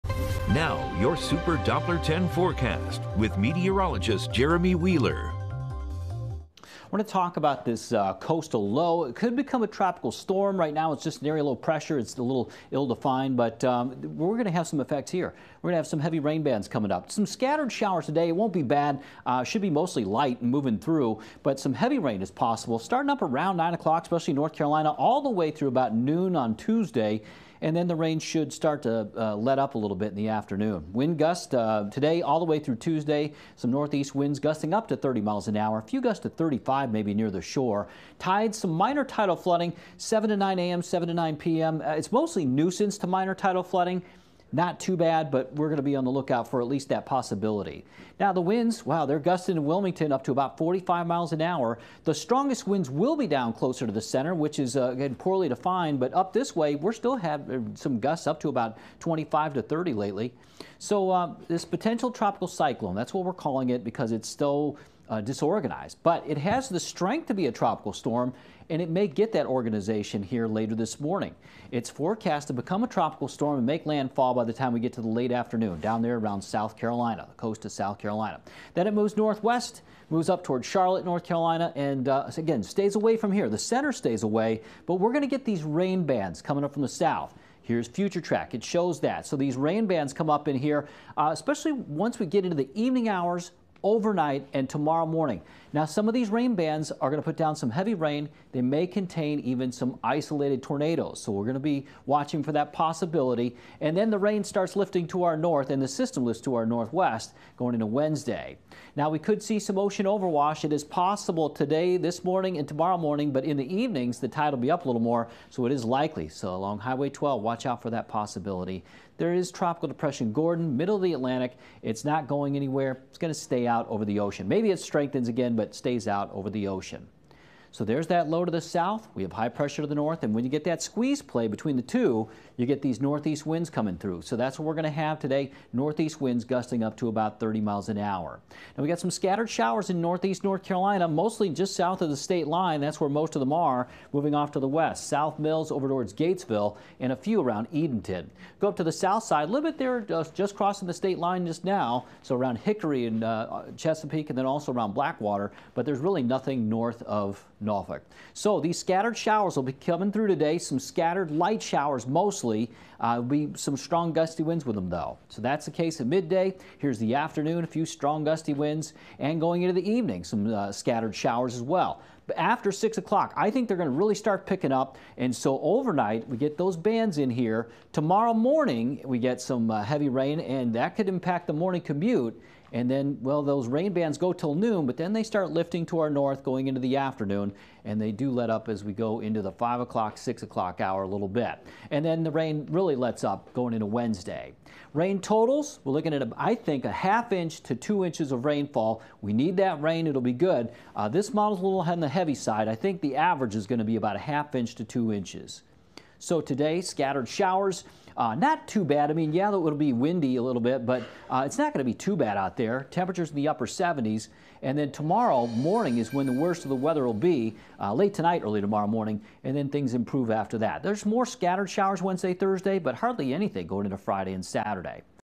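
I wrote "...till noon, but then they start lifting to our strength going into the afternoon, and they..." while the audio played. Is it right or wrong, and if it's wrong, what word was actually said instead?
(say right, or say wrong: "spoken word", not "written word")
wrong: "north", not "strength".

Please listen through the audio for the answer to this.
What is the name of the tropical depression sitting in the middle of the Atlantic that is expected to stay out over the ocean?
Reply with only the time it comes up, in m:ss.
2:00.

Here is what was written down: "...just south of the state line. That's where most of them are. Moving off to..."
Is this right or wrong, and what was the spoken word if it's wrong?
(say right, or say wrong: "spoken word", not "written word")
right.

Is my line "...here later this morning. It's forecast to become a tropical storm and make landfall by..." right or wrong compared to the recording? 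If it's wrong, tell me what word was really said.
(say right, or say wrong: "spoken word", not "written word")
right.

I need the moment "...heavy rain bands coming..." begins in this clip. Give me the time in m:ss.
0:16.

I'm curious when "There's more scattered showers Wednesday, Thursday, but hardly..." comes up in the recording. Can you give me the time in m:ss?
3:40.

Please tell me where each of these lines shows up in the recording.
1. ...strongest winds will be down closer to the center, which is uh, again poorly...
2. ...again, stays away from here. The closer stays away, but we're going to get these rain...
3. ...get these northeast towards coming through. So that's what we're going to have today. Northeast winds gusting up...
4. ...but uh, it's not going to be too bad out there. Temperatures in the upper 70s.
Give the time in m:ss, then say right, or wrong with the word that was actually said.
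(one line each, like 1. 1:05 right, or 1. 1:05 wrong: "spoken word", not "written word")
1. 0:52 right
2. 1:22 wrong: "center", not "closer"
3. 2:12 wrong: "winds", not "towards"
4. 3:30 right.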